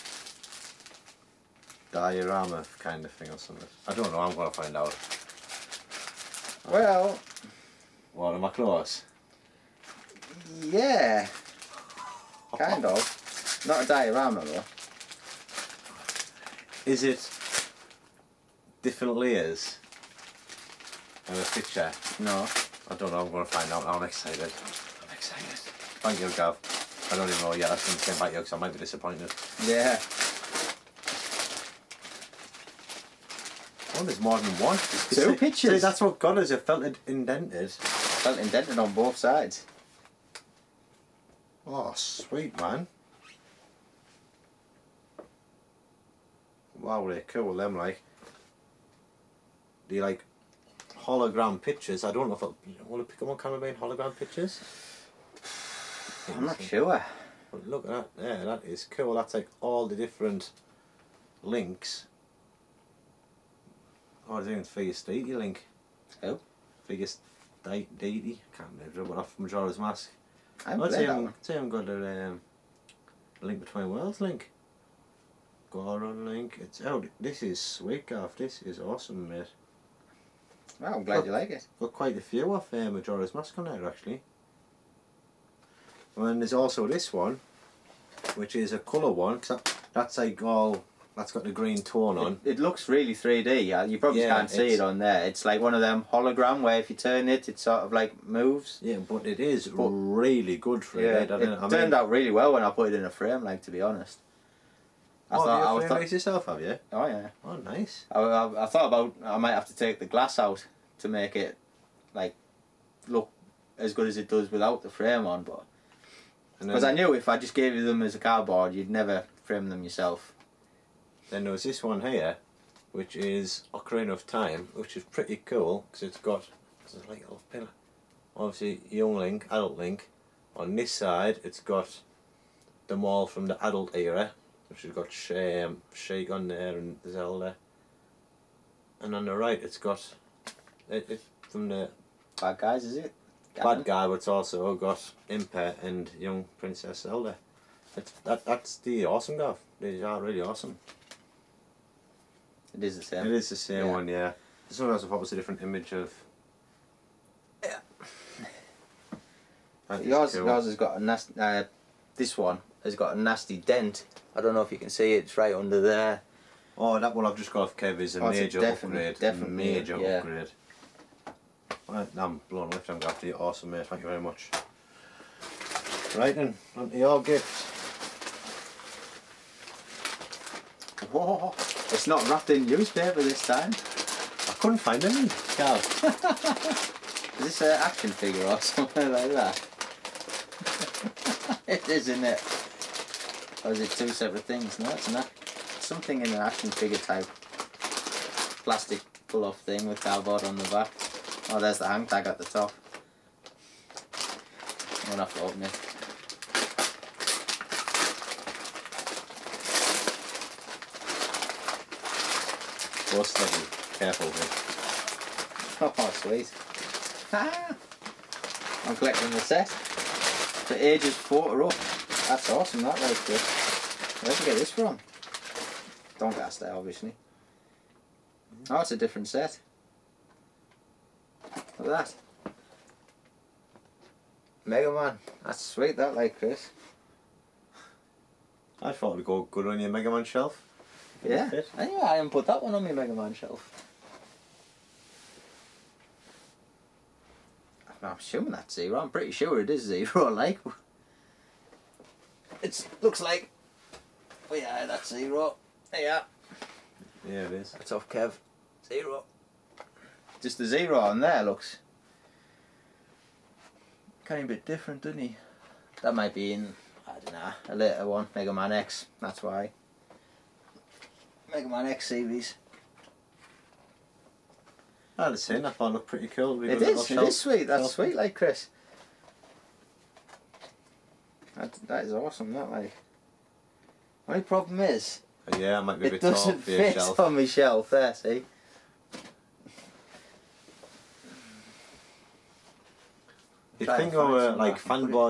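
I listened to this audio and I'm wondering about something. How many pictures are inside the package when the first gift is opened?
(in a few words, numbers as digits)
2.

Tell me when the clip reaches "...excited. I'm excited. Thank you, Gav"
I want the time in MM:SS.
00:24.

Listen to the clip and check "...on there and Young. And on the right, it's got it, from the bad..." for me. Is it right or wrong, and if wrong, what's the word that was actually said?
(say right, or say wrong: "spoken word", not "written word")
wrong: "Zelda", not "Young".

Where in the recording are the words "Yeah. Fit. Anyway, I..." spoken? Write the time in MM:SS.
04:01.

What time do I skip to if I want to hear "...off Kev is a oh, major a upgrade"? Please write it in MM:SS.
02:47.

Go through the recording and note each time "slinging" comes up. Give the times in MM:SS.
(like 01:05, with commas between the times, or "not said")
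03:33.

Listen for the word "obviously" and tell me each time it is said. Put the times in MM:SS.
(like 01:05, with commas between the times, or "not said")
02:08, 03:46.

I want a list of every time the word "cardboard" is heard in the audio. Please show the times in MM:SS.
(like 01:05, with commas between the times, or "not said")
01:58, 03:19.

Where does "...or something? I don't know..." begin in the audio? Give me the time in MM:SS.
00:03.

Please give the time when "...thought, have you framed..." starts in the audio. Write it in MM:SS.
01:45.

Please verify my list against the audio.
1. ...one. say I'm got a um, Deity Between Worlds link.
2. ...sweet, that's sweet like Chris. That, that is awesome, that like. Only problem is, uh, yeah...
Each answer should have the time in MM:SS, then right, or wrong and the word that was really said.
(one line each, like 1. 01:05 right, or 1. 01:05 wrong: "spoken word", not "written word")
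1. 01:11 wrong: "Link", not "Deity"
2. 04:37 right.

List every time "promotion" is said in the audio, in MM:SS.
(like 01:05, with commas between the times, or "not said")
not said.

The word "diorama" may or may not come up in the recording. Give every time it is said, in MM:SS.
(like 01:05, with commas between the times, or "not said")
00:01, 00:13.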